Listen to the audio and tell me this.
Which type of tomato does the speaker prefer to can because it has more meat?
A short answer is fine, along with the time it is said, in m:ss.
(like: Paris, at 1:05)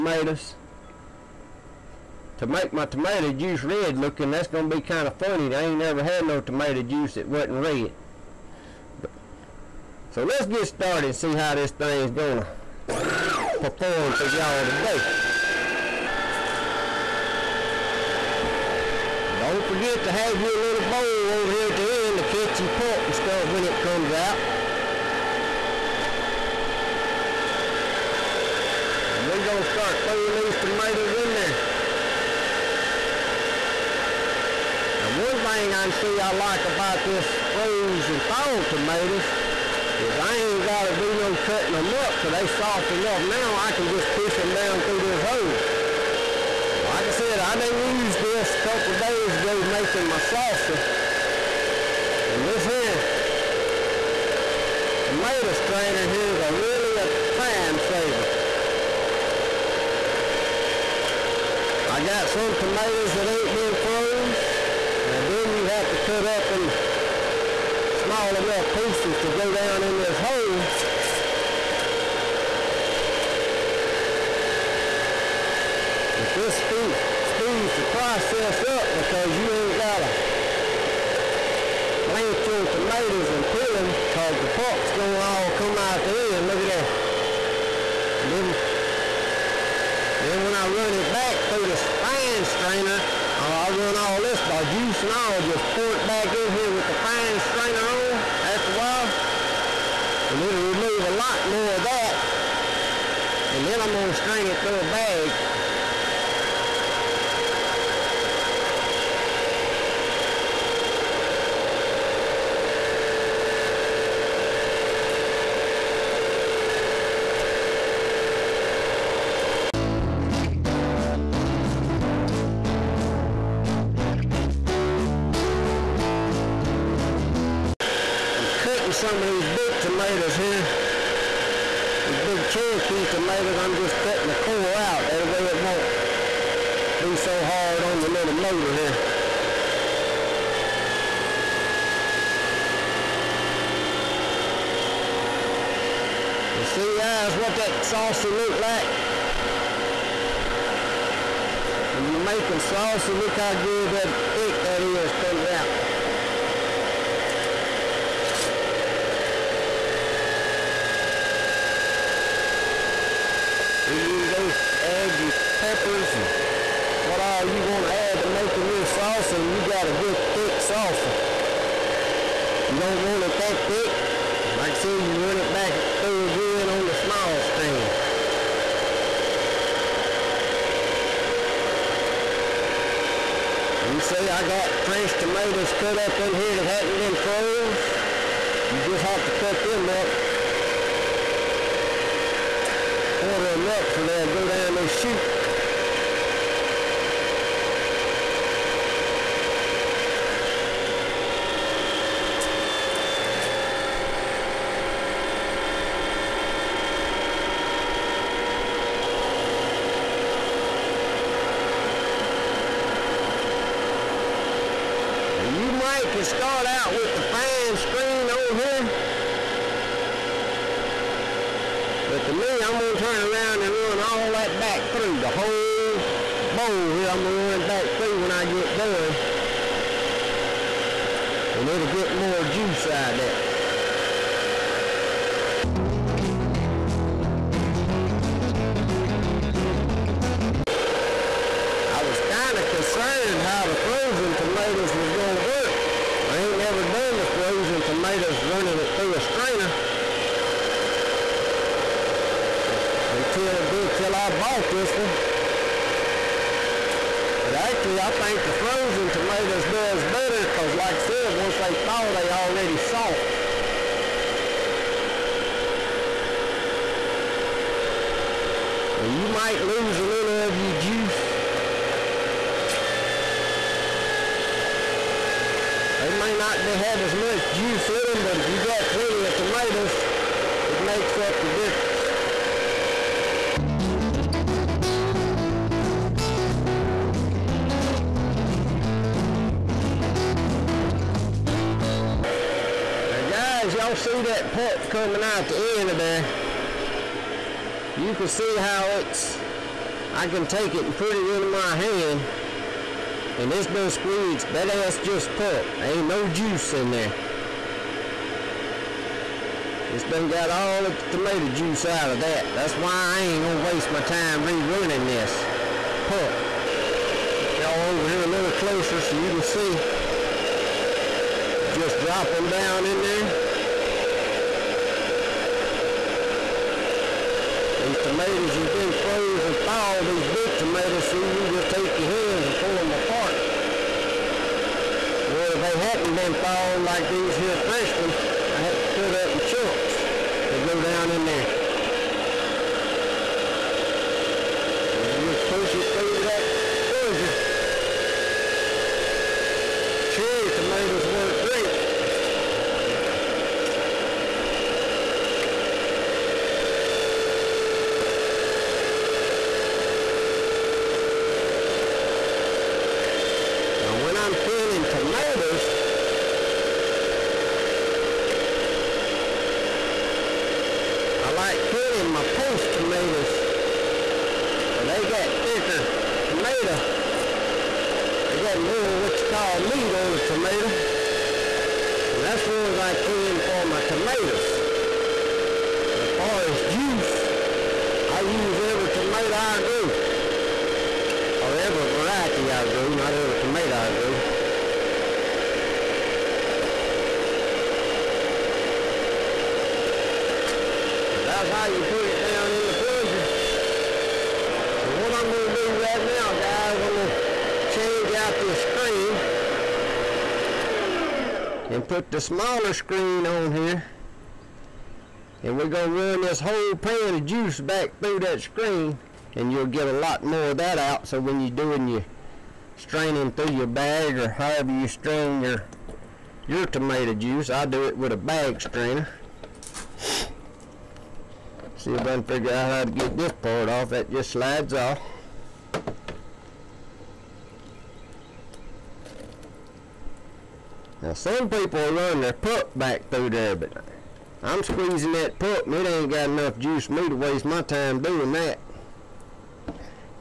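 Paste tomatoes, at 6:12.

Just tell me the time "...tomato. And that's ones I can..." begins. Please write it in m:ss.
6:20.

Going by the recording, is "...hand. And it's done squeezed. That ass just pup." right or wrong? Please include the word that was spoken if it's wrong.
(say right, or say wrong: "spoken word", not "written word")
right.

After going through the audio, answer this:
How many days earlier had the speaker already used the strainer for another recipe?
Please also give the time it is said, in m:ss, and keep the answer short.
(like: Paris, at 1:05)
A couple days, at 0:48.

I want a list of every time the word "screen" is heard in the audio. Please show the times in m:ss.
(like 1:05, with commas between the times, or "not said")
2:57, 3:37, 6:48, 6:52, 6:58.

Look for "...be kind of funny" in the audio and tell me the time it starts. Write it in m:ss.
0:04.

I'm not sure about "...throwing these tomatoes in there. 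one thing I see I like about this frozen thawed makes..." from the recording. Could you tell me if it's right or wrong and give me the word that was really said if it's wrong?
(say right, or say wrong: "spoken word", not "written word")
wrong: "tomatoes", not "makes".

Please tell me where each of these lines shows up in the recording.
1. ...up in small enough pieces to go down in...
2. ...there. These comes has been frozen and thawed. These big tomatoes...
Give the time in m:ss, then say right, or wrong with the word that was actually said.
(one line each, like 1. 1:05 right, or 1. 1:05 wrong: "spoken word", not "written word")
1. 1:06 right
2. 5:23 wrong: "tomatoes", not "comes".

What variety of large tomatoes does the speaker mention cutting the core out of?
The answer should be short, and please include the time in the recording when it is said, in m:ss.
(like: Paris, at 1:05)
Cherokee, at 2:12.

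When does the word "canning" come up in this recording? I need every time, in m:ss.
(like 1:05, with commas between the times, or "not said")
6:04, 6:11.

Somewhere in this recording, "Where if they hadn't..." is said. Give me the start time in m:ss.
5:35.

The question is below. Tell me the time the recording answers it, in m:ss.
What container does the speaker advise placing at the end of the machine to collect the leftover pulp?
0:20.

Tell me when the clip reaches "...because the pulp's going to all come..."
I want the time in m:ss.
1:24.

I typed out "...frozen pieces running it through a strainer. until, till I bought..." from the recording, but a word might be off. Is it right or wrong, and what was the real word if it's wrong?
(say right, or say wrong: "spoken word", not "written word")
wrong: "tomatoes", not "pieces".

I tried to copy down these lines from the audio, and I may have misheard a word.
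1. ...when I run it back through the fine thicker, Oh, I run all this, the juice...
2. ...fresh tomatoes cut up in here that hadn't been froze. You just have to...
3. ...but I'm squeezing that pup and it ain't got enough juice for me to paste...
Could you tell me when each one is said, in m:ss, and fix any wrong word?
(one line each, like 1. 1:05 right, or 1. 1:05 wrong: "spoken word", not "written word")
1. 1:30 wrong: "strainer", not "thicker"
2. 3:04 right
3. 7:23 wrong: "waste", not "paste".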